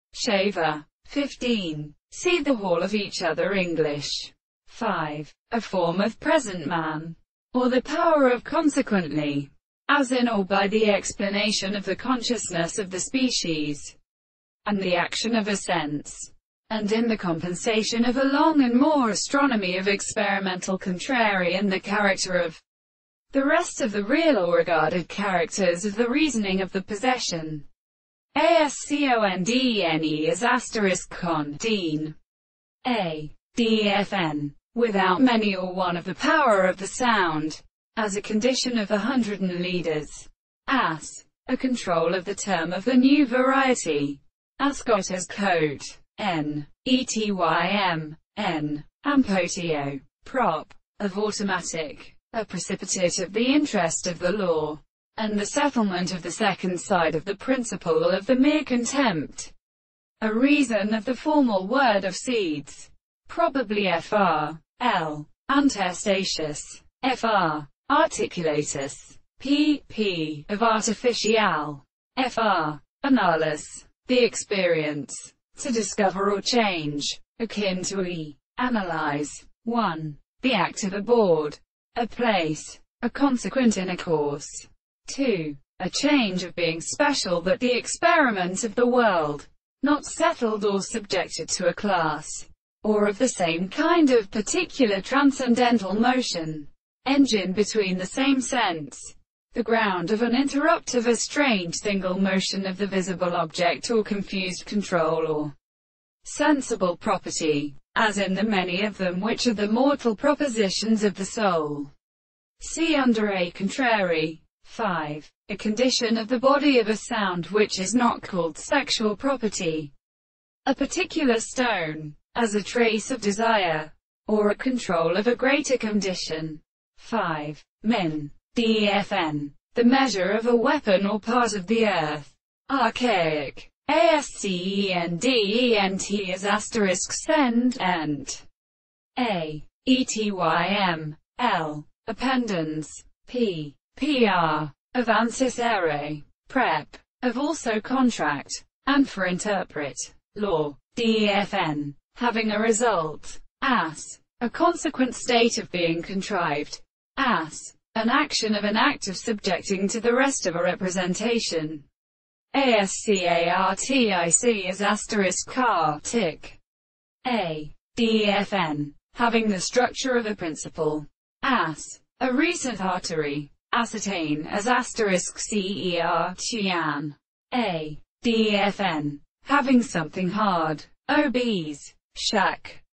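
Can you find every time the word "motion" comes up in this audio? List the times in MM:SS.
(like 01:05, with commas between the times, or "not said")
01:35, 01:42.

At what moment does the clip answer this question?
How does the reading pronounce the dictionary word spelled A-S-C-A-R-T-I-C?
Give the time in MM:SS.
02:44.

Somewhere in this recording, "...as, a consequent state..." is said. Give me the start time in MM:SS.
02:33.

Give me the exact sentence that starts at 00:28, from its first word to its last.
A S C O N D E N E is asterisk con, dean.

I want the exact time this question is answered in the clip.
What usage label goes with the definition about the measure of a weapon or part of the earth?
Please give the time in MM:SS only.
02:12.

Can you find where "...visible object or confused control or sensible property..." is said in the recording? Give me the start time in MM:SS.
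01:42.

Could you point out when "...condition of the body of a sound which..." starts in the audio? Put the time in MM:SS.
01:55.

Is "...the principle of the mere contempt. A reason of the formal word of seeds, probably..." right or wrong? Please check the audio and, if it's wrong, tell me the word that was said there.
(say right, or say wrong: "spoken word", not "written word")
right.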